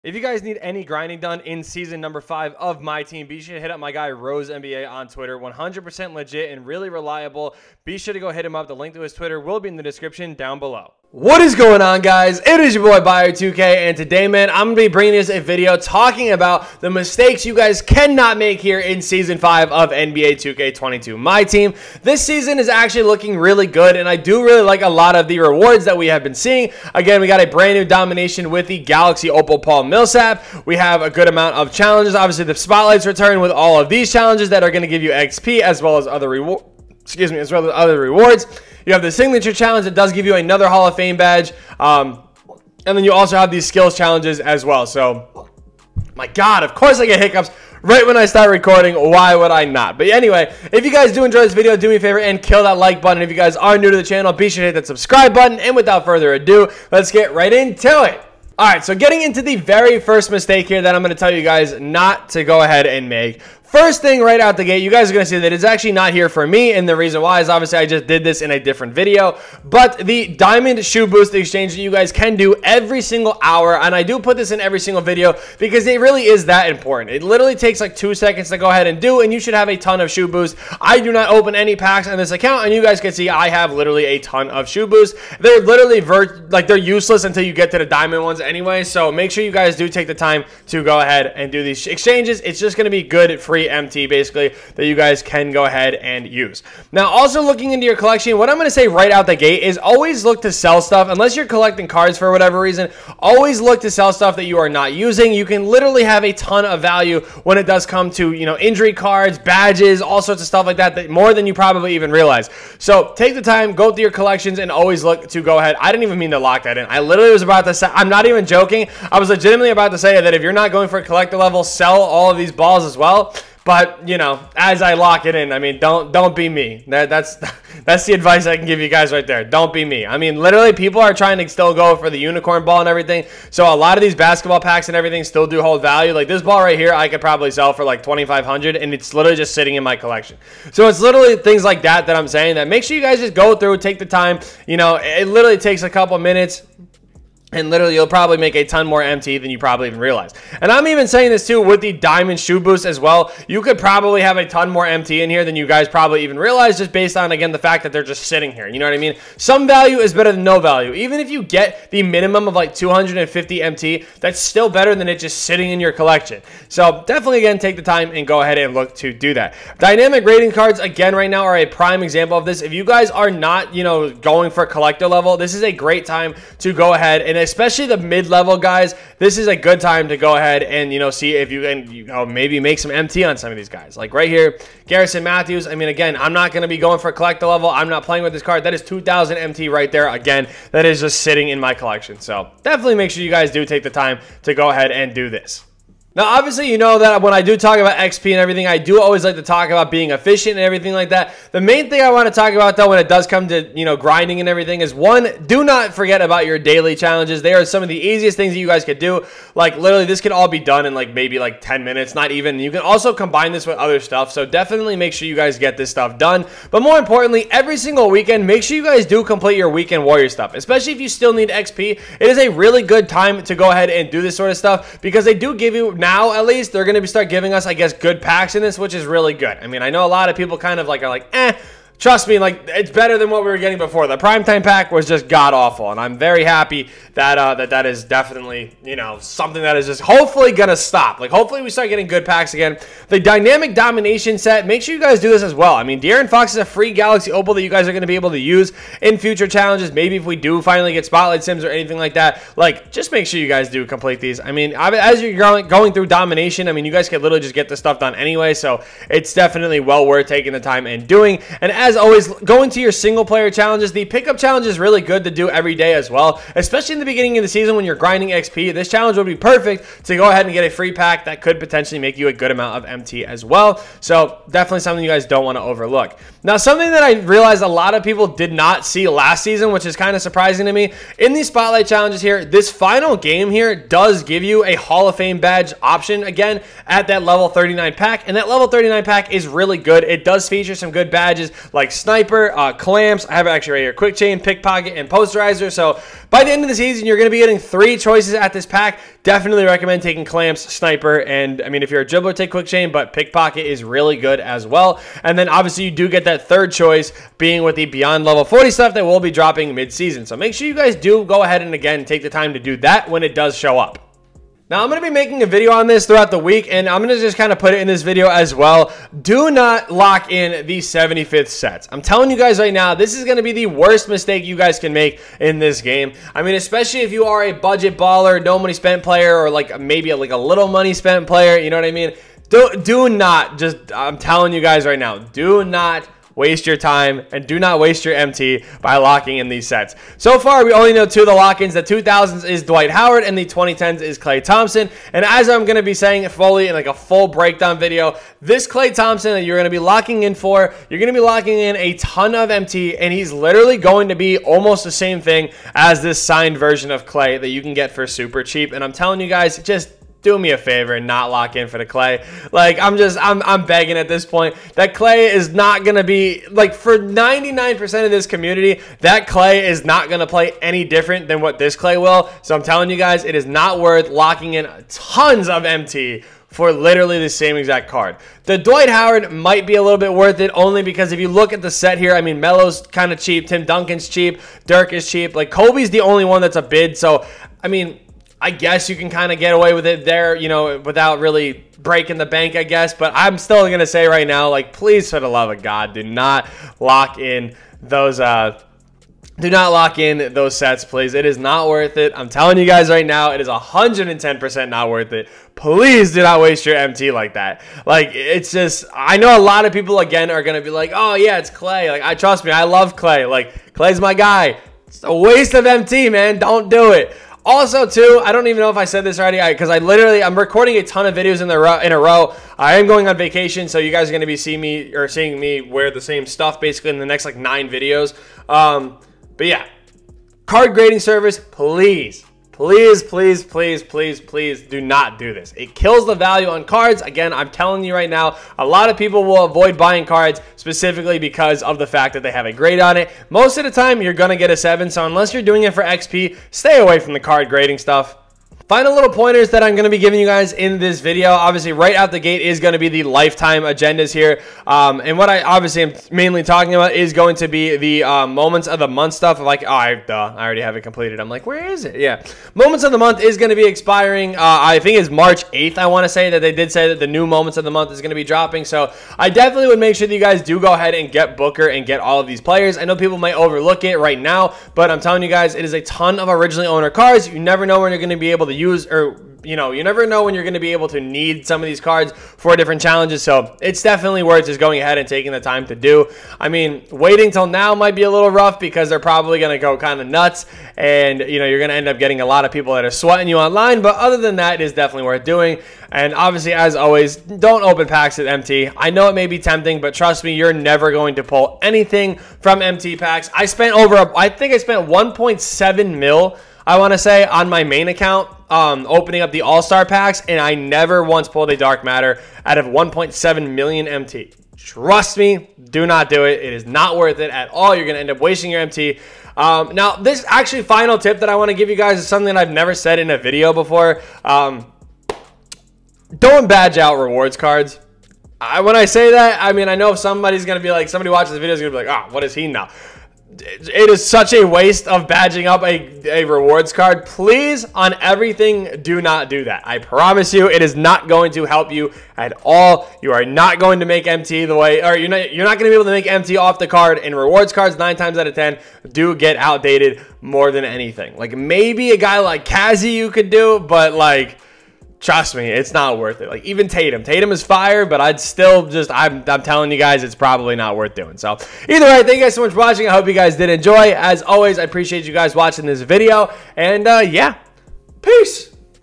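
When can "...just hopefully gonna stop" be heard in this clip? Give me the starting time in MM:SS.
03:59.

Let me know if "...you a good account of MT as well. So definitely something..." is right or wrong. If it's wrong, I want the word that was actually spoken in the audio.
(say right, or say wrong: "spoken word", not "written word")
wrong: "amount", not "account".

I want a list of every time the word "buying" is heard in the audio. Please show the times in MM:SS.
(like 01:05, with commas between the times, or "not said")
07:19.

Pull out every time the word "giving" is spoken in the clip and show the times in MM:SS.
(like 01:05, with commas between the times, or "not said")
03:47, 07:29.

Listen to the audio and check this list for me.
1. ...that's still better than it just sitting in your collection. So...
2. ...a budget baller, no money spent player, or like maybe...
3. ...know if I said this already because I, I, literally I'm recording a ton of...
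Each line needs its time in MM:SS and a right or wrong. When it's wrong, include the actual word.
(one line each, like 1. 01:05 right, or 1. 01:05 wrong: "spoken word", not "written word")
1. 02:44 right
2. 05:27 right
3. 06:58 right.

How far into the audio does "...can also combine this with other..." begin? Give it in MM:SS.
03:32.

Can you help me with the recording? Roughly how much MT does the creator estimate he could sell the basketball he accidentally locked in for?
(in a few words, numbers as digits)
2500.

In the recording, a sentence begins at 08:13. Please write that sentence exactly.
But other than that, it is definitely worth doing.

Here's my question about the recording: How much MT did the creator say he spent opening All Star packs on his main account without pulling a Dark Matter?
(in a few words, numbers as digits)
1.7 million.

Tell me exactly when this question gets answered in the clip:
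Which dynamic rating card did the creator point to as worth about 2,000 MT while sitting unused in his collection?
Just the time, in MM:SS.
03:04.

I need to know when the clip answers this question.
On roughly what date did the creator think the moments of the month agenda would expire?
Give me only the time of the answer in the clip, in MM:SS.
07:45.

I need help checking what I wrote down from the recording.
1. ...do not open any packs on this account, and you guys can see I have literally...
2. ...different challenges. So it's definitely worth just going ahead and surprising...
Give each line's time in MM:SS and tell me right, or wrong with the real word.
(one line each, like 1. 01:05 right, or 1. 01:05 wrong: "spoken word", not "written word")
1. 01:20 right
2. 08:02 wrong: "taking", not "surprising".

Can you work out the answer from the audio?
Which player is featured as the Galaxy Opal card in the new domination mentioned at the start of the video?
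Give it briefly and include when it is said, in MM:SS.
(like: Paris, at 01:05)
Paul Millsap, at 00:29.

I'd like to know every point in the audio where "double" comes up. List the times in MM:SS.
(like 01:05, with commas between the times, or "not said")
not said.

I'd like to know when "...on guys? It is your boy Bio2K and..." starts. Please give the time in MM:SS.
00:11.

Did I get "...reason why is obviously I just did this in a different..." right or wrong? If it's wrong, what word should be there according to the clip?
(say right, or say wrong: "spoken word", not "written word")
right.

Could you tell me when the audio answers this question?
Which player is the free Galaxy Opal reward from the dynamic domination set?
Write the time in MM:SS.
04:06.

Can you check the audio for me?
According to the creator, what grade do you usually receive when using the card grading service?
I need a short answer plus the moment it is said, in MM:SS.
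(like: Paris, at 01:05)
7, at 07:24.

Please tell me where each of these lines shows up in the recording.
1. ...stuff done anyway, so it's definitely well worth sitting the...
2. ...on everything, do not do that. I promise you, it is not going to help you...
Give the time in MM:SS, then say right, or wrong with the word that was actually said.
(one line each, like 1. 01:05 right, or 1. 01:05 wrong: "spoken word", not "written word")
1. 04:17 wrong: "taking", not "sitting"
2. 08:57 right.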